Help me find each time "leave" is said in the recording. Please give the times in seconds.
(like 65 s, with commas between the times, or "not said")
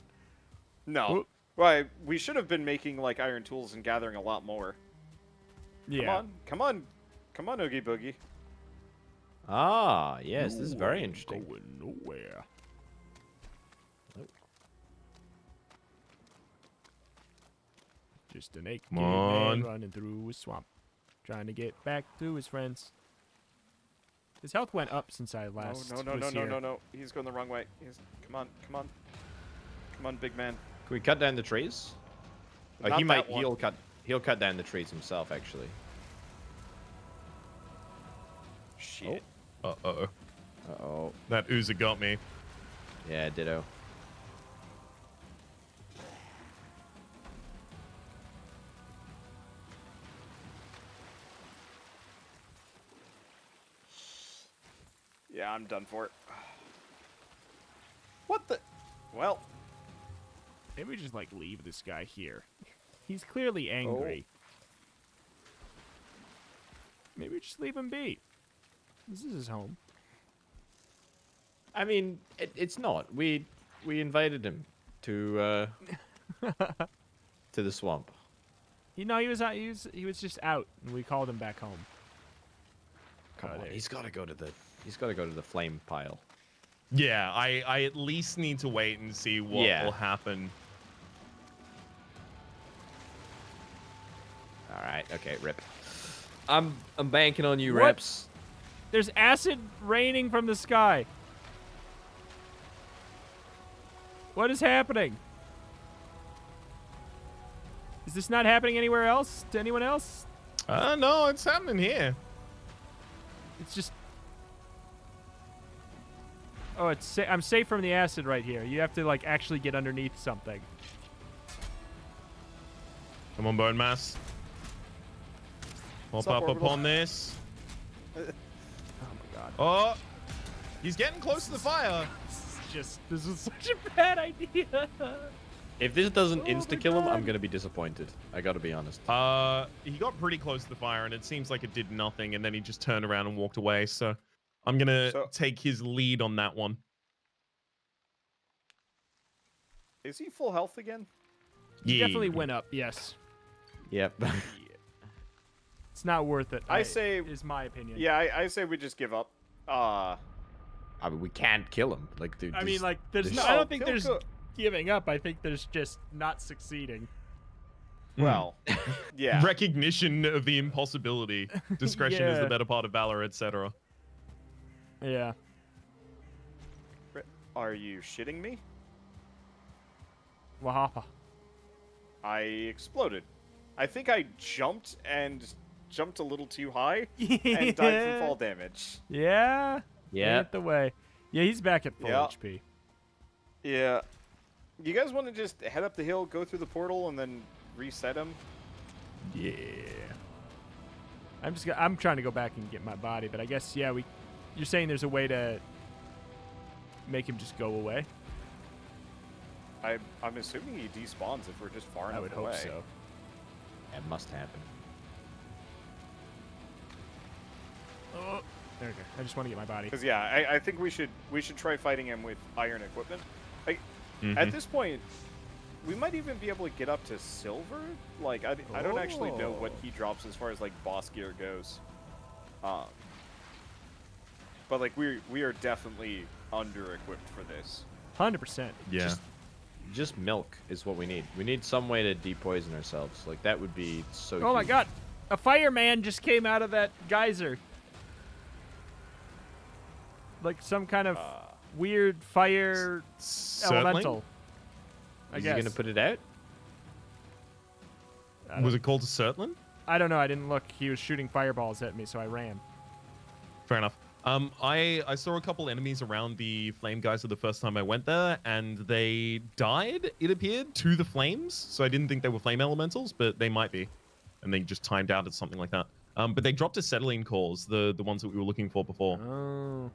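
61 s, 67 s.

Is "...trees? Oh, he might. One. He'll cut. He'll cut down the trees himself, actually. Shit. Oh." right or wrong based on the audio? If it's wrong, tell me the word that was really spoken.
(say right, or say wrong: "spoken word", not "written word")
right.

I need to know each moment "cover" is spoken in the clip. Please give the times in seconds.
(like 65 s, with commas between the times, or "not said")
not said.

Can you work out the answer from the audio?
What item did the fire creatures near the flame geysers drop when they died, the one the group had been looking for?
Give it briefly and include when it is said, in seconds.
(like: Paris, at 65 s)
Surtling cores, at 276 s.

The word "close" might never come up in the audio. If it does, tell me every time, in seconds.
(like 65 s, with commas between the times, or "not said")
131 s, 140 s.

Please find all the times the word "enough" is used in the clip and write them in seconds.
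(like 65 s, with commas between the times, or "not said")
212 s, 263 s.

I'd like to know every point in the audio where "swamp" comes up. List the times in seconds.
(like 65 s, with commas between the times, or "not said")
20 s, 77 s.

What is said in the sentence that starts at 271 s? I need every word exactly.
So I didn't think they were flame elementals, but they might be.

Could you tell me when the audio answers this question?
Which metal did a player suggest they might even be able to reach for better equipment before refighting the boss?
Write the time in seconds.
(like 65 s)
227 s.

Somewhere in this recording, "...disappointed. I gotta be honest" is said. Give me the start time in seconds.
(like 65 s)
137 s.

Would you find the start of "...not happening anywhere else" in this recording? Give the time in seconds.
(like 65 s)
108 s.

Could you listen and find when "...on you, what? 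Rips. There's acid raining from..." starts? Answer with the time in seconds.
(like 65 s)
97 s.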